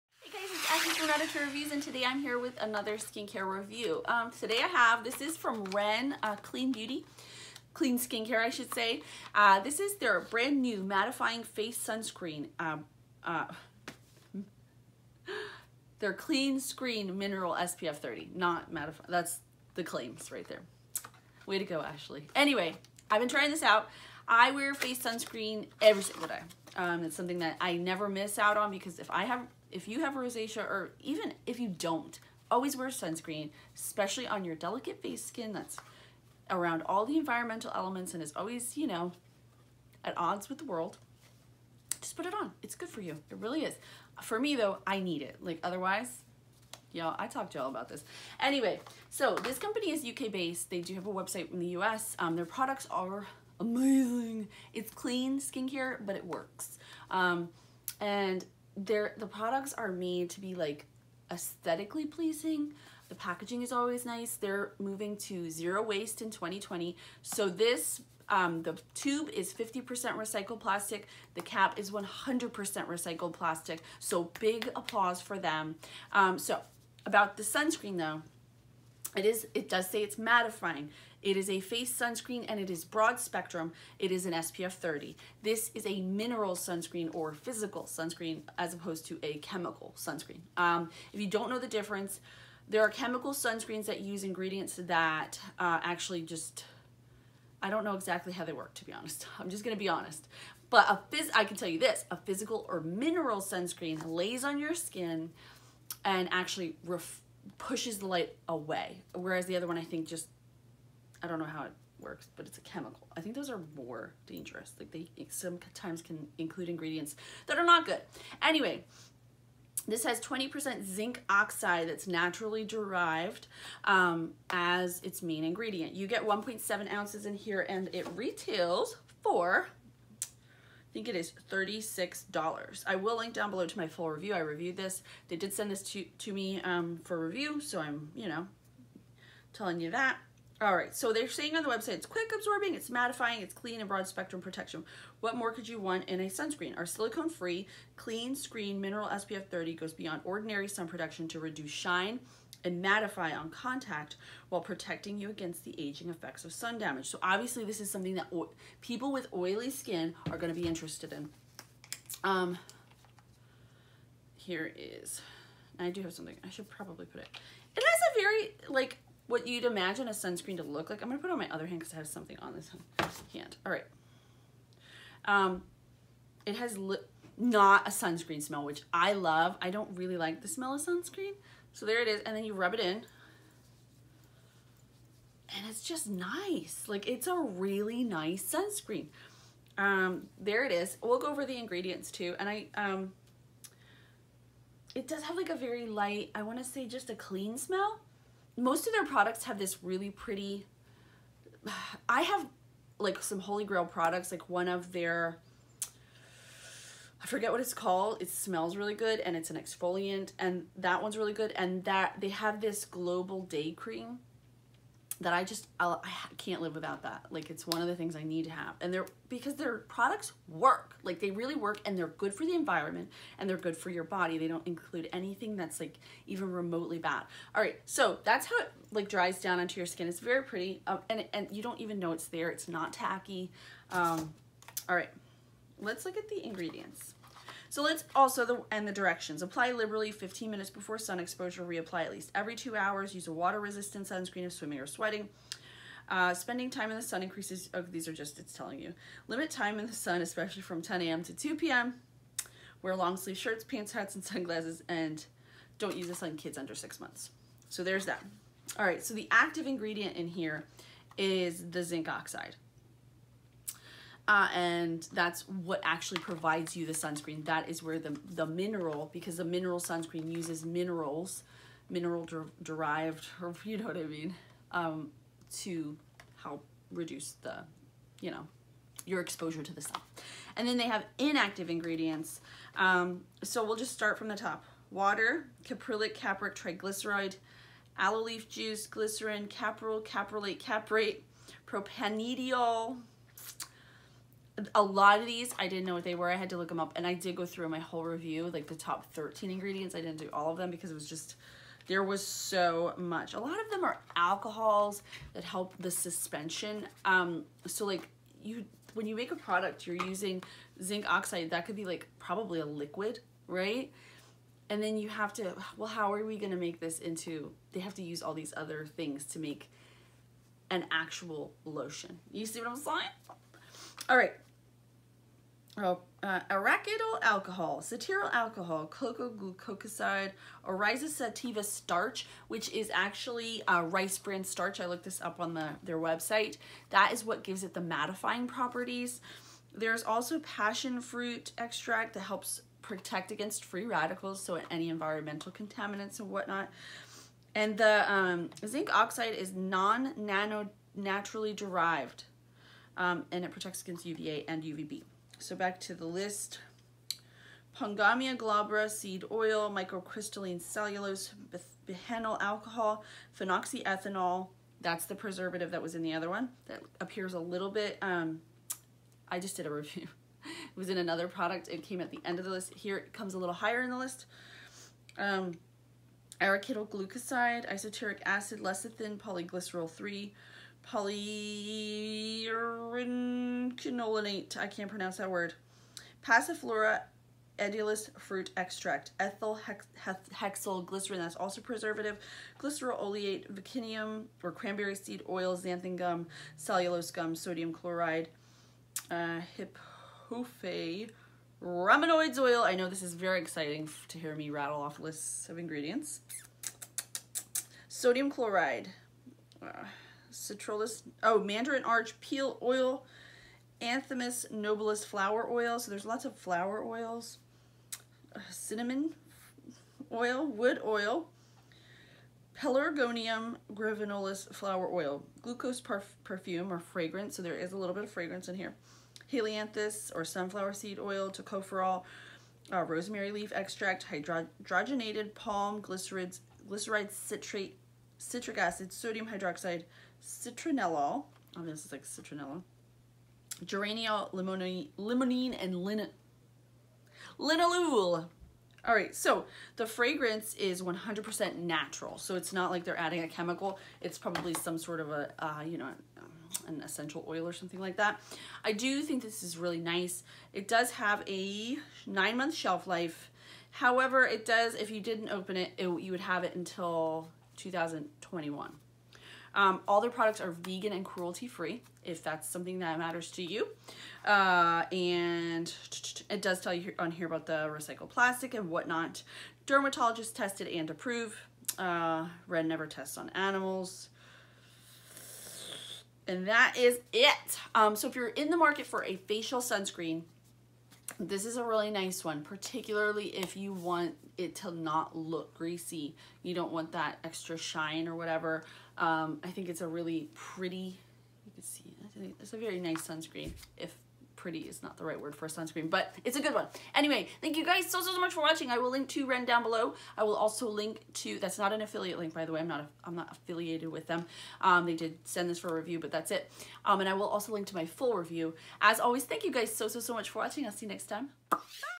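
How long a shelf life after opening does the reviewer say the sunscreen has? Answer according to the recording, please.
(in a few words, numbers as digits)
9 months.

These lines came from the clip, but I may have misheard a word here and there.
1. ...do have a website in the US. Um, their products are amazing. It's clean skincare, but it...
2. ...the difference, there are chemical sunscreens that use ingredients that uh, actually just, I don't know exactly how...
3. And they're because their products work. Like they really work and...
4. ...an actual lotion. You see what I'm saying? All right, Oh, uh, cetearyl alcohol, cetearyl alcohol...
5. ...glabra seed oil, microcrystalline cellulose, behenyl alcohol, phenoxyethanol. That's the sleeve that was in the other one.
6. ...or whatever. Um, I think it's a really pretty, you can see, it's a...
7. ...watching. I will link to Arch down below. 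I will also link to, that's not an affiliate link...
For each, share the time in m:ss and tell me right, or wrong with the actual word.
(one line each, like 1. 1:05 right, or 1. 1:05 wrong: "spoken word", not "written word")
1. 0:50 right
2. 1:31 right
3. 3:38 right
4. 5:20 wrong: "arachidyl", not "cetearyl"
5. 5:58 wrong: "preservative", not "sleeve"
6. 8:18 right
7. 8:28 wrong: "Ren", not "Arch".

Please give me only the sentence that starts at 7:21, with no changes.
Oh, this is like citronella, geranium, limonene, limonene and lin linalool.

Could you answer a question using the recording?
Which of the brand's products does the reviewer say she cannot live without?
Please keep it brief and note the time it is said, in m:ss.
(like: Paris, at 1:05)
global day cream, at 3:32.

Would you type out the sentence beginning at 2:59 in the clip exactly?
I don't really like the smell of sunscreen.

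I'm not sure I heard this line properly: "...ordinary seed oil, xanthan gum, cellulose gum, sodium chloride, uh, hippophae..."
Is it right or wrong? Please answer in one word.
wrong.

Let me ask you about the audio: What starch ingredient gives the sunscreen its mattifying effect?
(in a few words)
rice bran starch.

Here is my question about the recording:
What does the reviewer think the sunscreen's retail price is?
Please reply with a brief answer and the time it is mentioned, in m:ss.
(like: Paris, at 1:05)
$36, at 2:11.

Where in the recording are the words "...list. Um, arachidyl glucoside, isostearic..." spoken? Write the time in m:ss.
6:13.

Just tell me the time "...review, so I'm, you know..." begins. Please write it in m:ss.
2:17.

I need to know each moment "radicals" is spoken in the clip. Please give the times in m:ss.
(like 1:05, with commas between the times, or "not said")
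5:43.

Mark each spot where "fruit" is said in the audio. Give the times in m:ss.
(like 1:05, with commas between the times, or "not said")
5:40, 6:28.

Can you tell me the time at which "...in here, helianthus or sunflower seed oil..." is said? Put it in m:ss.
7:08.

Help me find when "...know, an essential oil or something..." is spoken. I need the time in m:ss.
7:35.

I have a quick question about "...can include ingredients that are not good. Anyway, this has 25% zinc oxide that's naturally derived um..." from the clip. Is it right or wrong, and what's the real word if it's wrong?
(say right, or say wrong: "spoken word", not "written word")
wrong: "20", not "25".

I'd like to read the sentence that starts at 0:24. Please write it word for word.
I wear face sunscreen every single day.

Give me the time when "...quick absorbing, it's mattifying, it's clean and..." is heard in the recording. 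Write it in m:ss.
2:22.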